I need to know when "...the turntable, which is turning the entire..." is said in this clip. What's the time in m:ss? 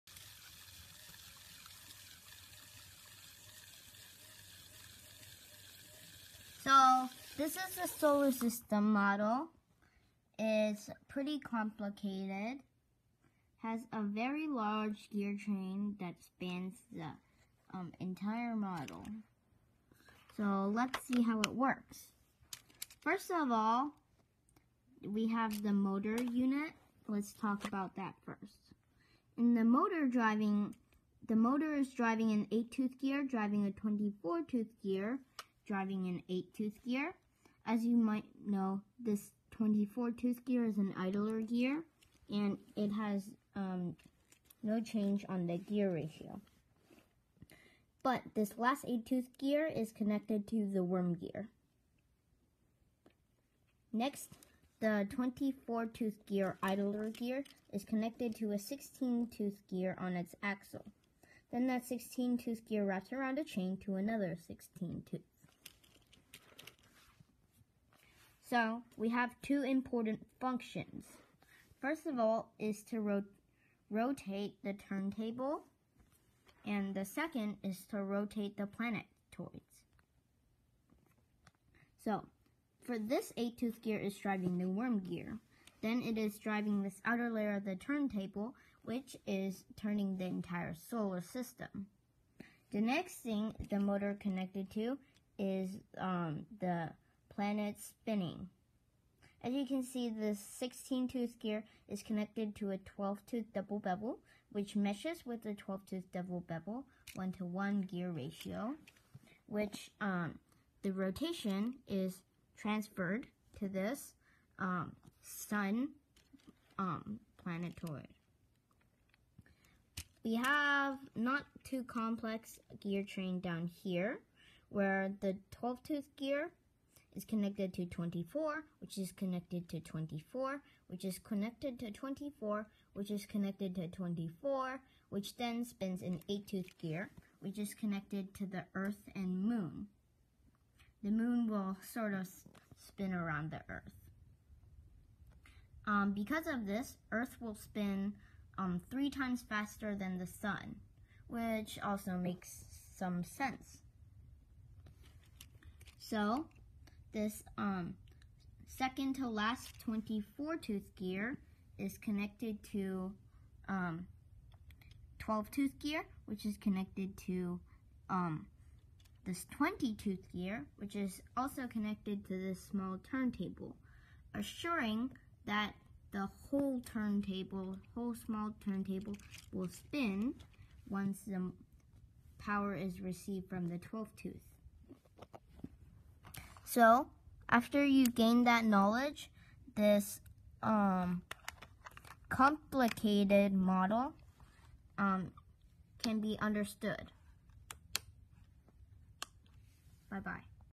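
1:27.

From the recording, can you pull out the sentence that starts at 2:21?
The Moon will sort of spin around the Earth.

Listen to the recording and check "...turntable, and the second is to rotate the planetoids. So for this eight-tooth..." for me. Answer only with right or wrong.
right.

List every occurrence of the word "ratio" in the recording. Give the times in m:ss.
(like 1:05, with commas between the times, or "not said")
0:45, 1:48.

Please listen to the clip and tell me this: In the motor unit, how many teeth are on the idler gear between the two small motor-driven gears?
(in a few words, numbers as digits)
24.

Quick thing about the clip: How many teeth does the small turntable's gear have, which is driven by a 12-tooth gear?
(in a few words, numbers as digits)
20.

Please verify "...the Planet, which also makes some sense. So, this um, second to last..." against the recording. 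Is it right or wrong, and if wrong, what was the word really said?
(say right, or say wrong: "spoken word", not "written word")
wrong: "Sun", not "Planet".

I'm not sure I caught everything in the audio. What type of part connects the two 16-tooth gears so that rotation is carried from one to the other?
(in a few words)
chain.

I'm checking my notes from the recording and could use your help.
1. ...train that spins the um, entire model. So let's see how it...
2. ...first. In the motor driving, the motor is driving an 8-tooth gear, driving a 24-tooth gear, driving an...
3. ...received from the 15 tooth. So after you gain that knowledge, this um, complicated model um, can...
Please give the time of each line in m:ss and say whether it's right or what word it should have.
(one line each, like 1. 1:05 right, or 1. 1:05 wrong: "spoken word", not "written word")
1. 0:15 wrong: "spans", not "spins"
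2. 0:28 right
3. 3:03 wrong: "12", not "15".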